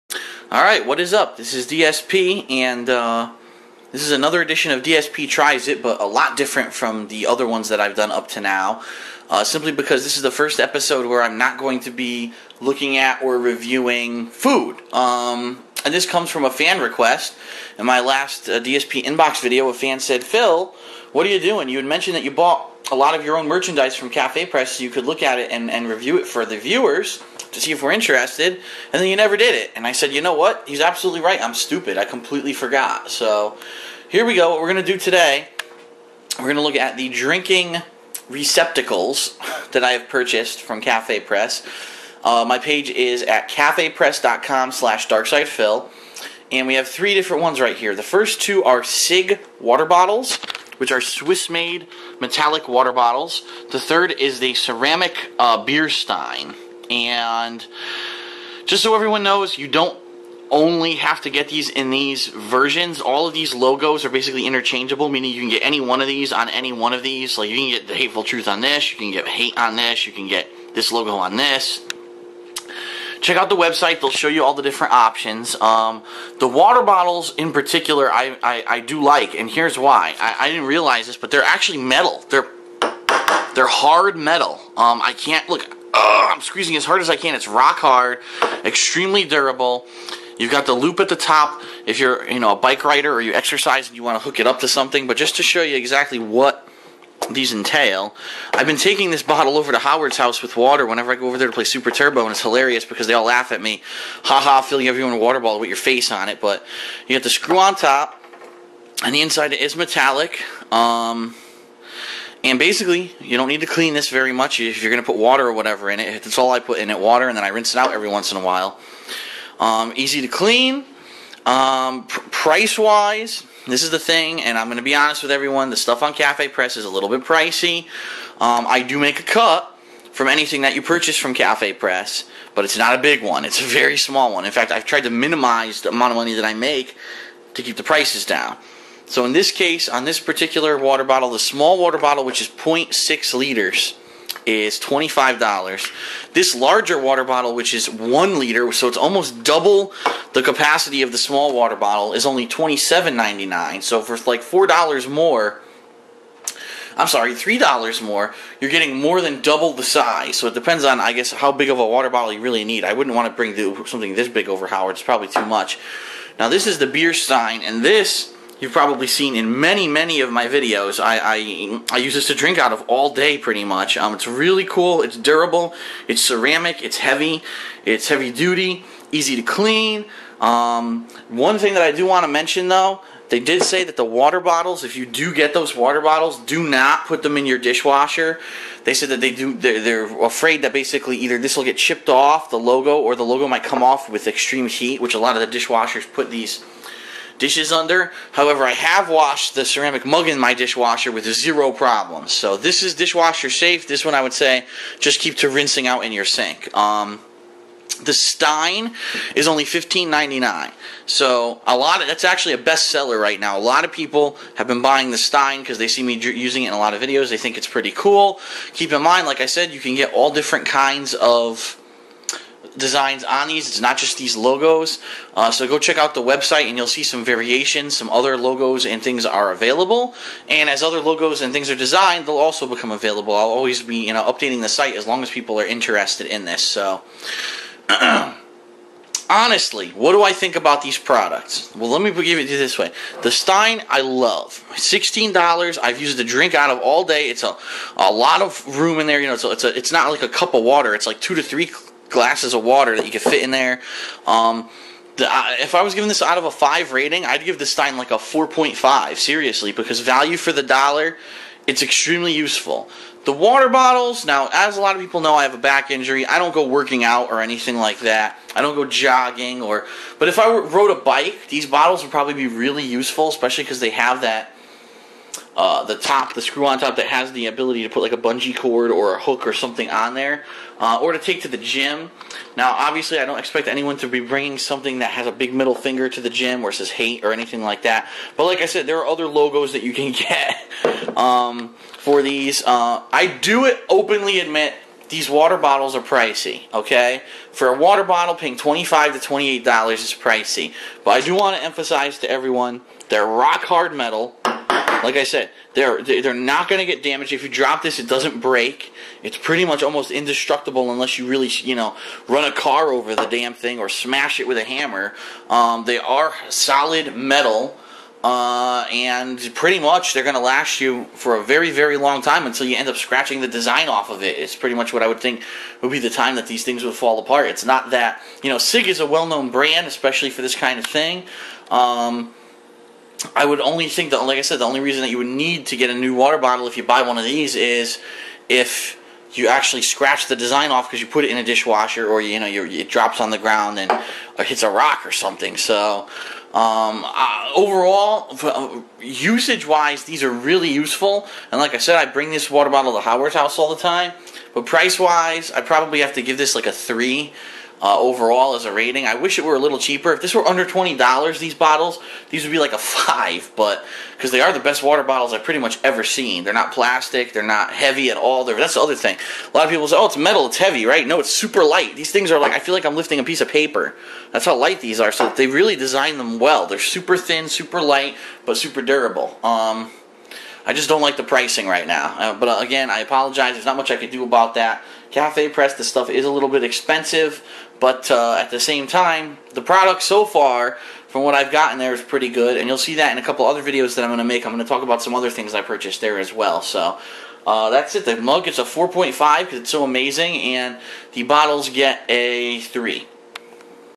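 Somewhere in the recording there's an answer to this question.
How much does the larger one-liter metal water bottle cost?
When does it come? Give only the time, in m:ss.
2:32.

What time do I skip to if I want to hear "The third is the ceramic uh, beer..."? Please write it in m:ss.
0:53.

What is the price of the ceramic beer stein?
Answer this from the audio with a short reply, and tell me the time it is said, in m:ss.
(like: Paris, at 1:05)
$15.99, at 3:29.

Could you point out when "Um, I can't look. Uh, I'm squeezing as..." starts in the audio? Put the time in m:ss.
1:24.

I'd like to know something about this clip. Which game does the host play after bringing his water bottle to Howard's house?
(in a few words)
Super Turbo.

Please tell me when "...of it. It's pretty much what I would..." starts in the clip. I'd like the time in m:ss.
5:24.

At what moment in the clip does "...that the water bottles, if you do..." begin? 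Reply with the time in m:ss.
3:03.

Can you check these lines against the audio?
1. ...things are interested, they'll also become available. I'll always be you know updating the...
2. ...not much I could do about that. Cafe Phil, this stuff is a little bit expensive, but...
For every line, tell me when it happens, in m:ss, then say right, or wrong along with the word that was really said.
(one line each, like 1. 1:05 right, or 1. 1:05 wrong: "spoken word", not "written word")
1. 3:51 wrong: "designed", not "interested"
2. 6:23 wrong: "Press", not "Phil".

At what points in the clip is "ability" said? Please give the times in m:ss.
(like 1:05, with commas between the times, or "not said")
4:37.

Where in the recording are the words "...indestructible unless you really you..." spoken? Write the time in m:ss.
5:10.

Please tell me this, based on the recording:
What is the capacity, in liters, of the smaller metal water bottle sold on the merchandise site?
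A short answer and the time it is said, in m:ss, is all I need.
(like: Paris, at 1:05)
0.6 liters, at 2:22.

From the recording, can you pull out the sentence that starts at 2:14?
In fact, I've tried to minimize the amount of money that I make to keep the prices down.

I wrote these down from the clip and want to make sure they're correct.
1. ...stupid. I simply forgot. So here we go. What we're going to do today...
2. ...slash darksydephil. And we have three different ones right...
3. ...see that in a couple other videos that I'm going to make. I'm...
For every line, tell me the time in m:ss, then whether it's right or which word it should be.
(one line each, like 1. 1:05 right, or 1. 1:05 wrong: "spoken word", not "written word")
1. 0:31 wrong: "completely", not "simply"
2. 0:44 right
3. 6:32 right.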